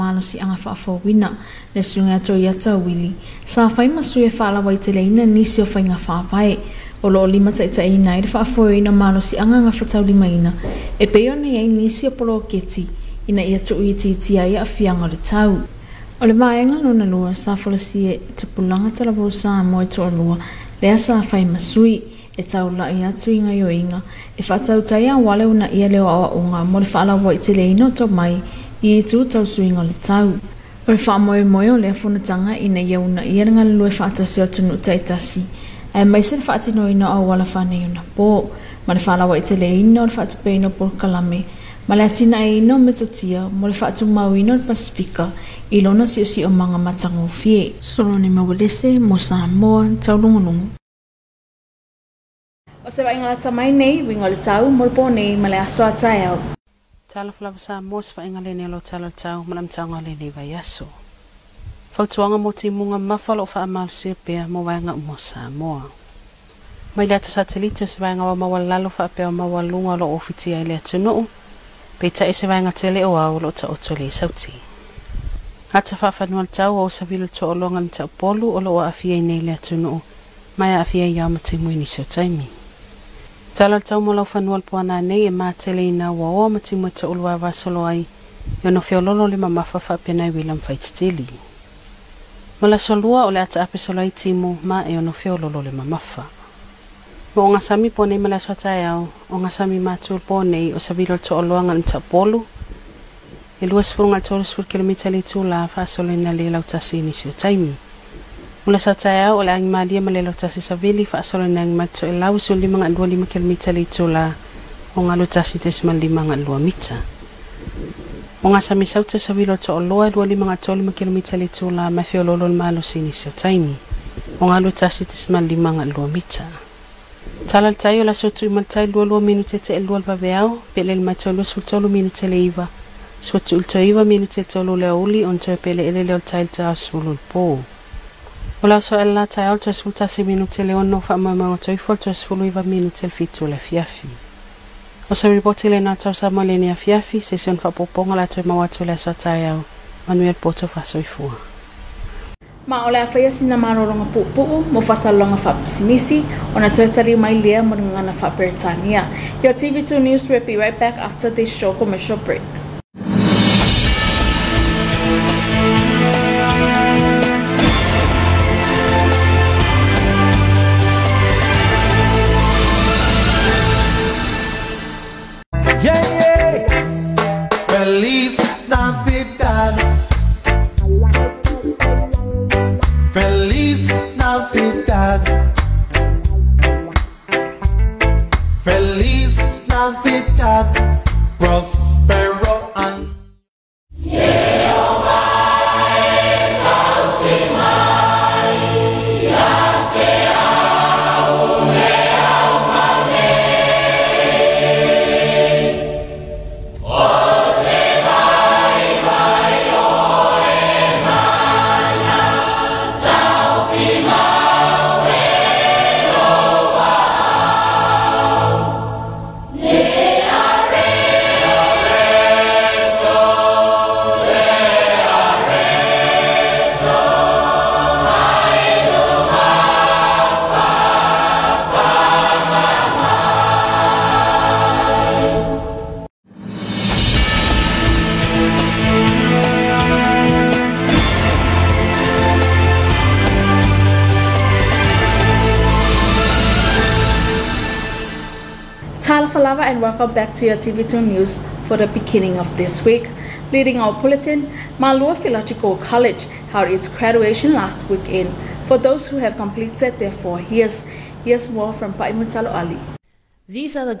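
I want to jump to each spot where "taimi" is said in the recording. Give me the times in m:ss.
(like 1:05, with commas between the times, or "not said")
1:22, 1:47, 2:03.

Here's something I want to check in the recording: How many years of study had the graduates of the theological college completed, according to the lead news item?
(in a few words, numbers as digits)
4.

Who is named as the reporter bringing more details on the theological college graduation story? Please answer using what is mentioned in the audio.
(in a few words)
Paimutalo Ali.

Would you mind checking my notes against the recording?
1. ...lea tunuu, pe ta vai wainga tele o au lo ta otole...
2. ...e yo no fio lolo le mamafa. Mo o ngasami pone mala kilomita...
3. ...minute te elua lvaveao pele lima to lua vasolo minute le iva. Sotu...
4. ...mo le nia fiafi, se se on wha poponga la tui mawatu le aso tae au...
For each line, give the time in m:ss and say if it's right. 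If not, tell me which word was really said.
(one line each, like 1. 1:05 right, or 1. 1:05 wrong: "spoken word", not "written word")
1. 1:10 right
2. 1:34 wrong: "swata", not "kilomita"
3. 2:09 wrong: "sultolo", not "vasolo"
4. 2:26 right.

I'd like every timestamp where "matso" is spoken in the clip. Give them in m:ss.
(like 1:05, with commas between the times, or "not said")
1:51.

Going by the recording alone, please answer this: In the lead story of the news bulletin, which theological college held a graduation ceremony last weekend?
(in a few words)
Malua Theological College.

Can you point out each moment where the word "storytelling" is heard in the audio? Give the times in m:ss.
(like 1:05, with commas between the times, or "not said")
not said.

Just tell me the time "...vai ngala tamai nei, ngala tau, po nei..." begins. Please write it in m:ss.
0:53.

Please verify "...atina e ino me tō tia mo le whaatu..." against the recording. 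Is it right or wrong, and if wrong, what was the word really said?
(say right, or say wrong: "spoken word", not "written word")
right.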